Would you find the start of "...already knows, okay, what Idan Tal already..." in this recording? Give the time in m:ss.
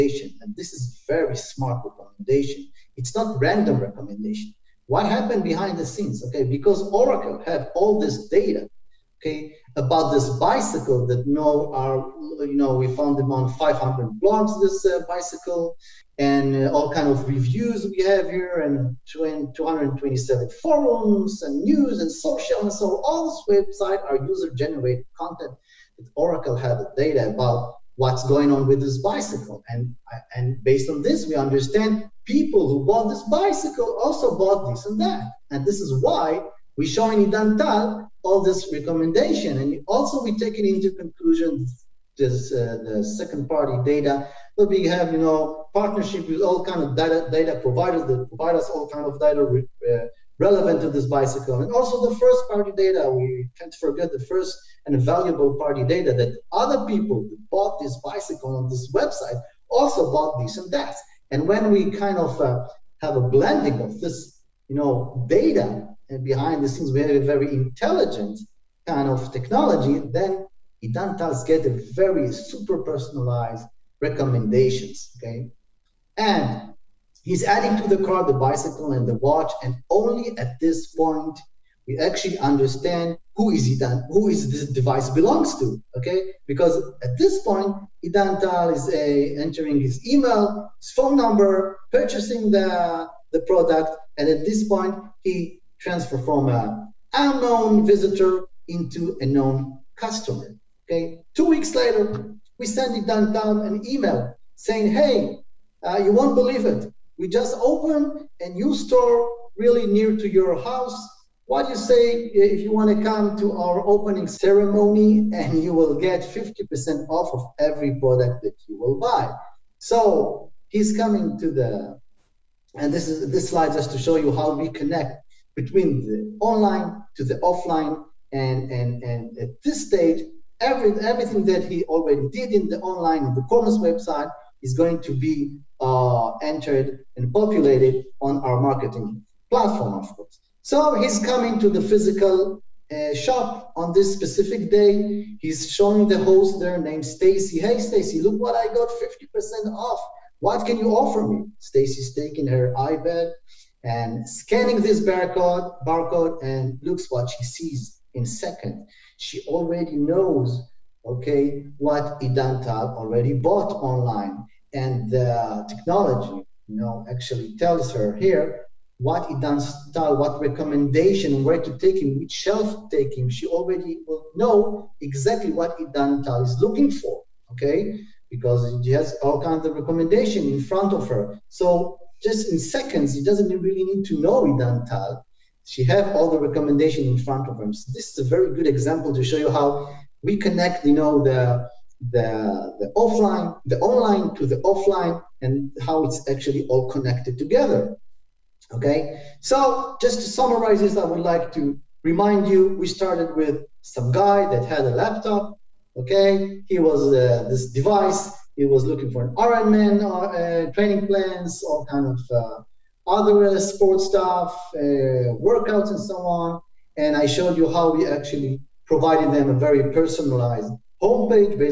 2:39.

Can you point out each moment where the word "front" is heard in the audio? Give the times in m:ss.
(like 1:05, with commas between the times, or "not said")
3:00, 3:07.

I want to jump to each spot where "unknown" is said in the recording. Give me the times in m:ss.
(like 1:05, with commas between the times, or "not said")
1:37.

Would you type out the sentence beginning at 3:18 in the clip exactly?
Okay, so just to summarize this, I would like to remind you we started with some guy that had a laptop.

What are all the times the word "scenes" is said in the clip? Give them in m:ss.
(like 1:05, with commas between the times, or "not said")
0:05, 1:06.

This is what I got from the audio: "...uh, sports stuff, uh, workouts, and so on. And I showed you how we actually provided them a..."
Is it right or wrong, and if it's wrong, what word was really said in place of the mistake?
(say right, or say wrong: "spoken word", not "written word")
right.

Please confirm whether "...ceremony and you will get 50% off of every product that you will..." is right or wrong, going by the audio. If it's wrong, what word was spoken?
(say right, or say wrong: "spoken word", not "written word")
right.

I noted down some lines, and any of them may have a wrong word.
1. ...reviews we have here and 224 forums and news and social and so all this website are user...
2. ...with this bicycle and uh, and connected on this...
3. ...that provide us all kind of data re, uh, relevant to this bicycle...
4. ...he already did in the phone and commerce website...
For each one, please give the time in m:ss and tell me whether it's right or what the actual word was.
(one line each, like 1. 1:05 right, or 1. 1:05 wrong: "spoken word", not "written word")
1. 0:17 wrong: "227", not "224"
2. 0:28 wrong: "based", not "connected"
3. 0:48 right
4. 2:11 wrong: "online", not "phone".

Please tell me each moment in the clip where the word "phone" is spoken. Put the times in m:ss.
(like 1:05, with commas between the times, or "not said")
1:30.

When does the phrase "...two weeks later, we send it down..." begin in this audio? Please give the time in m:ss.
1:41.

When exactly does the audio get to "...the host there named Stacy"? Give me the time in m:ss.
2:26.